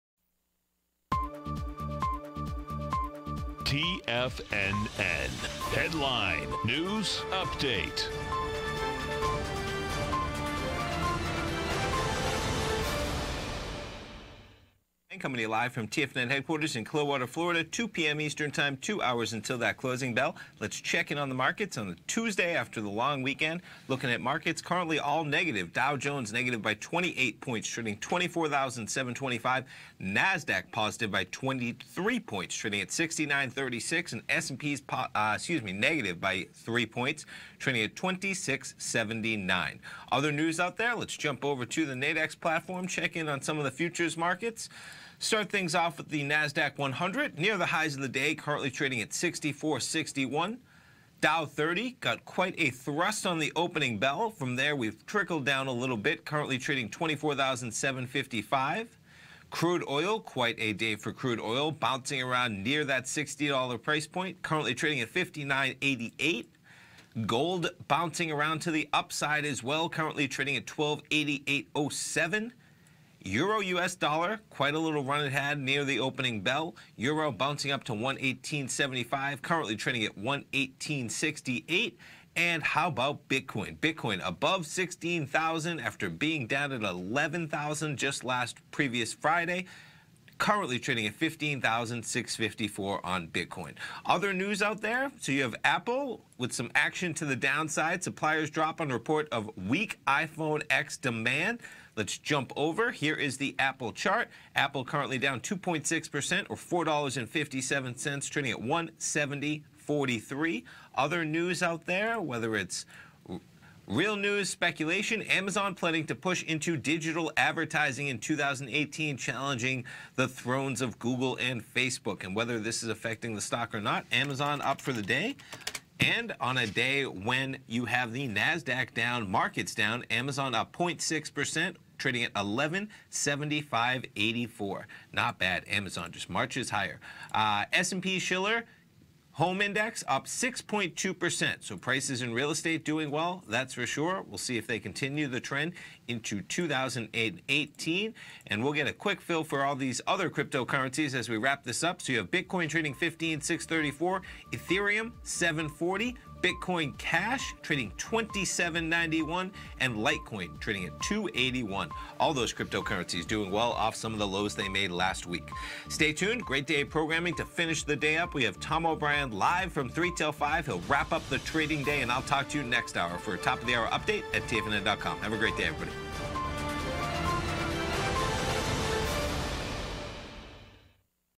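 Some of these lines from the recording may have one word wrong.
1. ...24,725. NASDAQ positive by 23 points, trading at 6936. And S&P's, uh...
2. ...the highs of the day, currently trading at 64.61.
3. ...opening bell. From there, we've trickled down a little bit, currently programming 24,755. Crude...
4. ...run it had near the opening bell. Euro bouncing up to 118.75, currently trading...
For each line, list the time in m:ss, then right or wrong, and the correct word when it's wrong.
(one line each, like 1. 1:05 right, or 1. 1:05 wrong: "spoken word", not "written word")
1. 0:27 right
2. 0:47 right
3. 0:53 wrong: "trading", not "programming"
4. 1:15 right.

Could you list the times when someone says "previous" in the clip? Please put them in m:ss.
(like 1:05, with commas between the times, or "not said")
1:28.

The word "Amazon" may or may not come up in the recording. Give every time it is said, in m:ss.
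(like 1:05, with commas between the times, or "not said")
1:55, 2:04, 2:10, 2:15.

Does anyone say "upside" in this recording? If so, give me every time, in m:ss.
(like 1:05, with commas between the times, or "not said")
1:08.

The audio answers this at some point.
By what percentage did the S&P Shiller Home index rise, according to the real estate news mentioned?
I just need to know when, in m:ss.
2:20.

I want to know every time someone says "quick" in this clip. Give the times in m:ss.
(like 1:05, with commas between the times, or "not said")
2:28.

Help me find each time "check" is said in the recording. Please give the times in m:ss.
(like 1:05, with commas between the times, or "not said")
0:20, 0:42.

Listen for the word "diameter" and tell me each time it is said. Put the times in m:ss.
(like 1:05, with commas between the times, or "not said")
not said.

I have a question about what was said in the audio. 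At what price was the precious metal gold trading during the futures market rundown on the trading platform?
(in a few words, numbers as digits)
1288.07.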